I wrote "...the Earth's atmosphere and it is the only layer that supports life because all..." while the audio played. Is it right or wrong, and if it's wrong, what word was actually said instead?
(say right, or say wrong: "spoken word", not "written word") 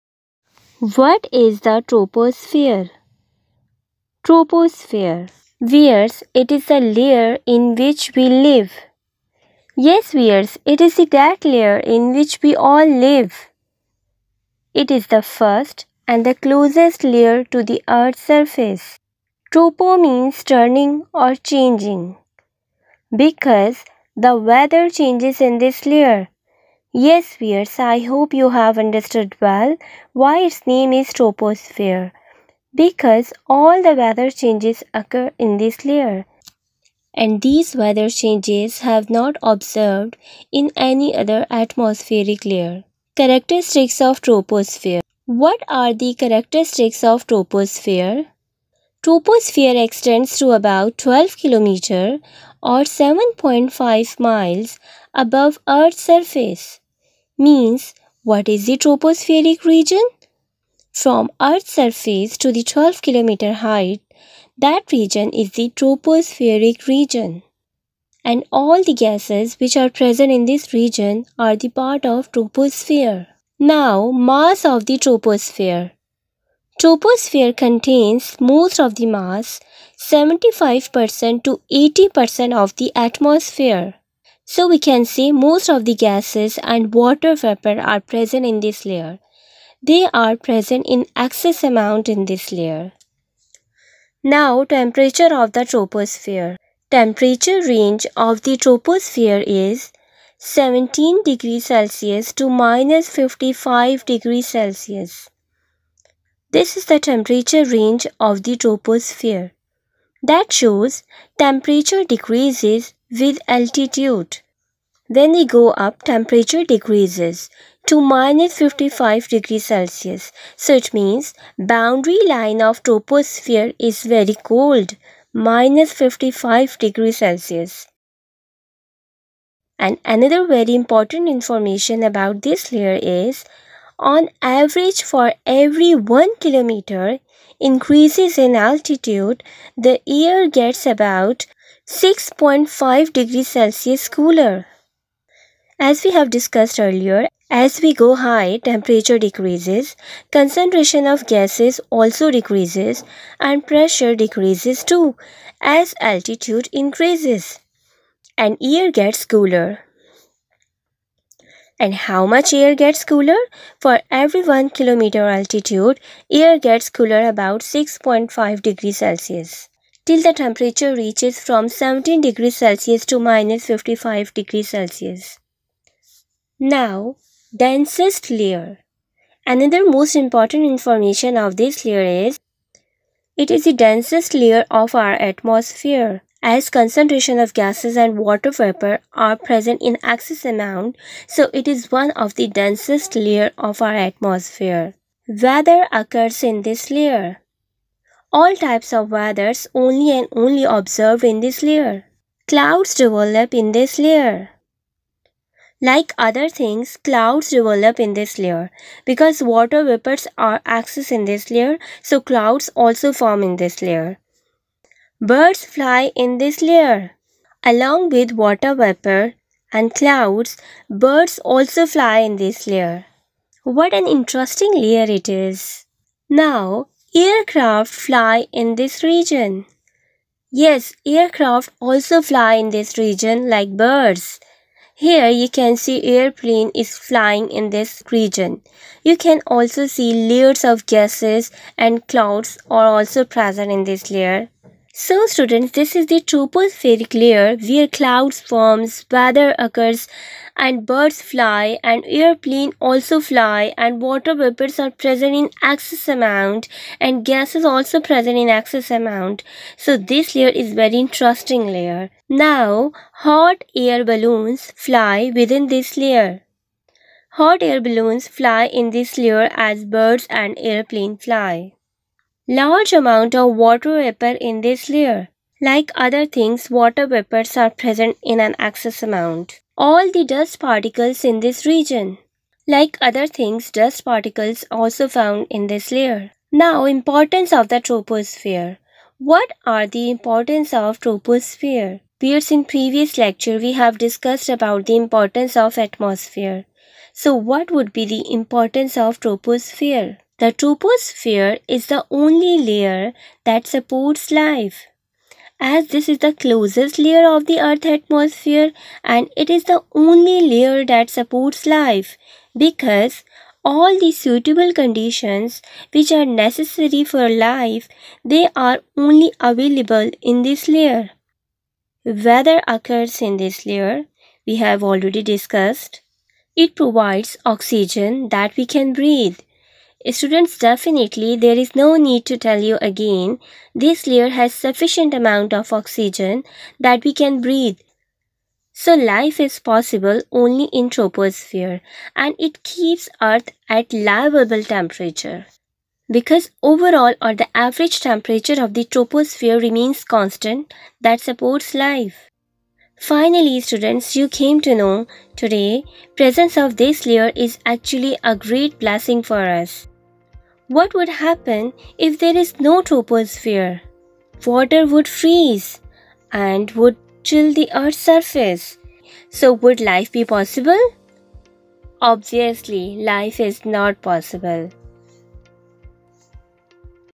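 right.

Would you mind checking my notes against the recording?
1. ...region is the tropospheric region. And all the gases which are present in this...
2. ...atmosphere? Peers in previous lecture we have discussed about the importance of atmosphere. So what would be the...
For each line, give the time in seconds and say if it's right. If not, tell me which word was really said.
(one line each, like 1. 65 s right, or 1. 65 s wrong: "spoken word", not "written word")
1. 64 s right
2. 290 s wrong: "troposphere", not "atmosphere".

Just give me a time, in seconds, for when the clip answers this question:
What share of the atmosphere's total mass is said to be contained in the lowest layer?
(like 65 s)
79 s.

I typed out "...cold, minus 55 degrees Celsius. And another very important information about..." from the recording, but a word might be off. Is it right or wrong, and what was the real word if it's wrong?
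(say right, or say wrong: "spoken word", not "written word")
right.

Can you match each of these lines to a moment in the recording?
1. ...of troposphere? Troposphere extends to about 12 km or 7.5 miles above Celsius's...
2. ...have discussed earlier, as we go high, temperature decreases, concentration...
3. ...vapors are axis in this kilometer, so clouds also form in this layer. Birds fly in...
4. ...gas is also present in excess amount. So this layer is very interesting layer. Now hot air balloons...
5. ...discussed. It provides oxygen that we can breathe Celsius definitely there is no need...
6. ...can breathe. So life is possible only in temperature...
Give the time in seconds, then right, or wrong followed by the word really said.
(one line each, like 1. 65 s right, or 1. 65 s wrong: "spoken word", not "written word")
1. 47 s wrong: "Earth", not "Celsius"
2. 146 s right
3. 209 s wrong: "layer", not "kilometer"
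4. 257 s right
5. 325 s wrong: "Students", not "Celsius"
6. 337 s wrong: "troposphere", not "temperature".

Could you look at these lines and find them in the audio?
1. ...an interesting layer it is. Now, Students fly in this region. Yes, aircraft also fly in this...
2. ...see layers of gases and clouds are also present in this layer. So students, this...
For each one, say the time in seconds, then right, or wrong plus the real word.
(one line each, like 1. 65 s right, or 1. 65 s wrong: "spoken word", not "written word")
1. 223 s wrong: "Aircraft", not "Students"
2. 239 s right.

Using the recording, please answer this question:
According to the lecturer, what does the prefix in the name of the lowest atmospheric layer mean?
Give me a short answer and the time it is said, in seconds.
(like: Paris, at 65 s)
turning or changing, at 20 s.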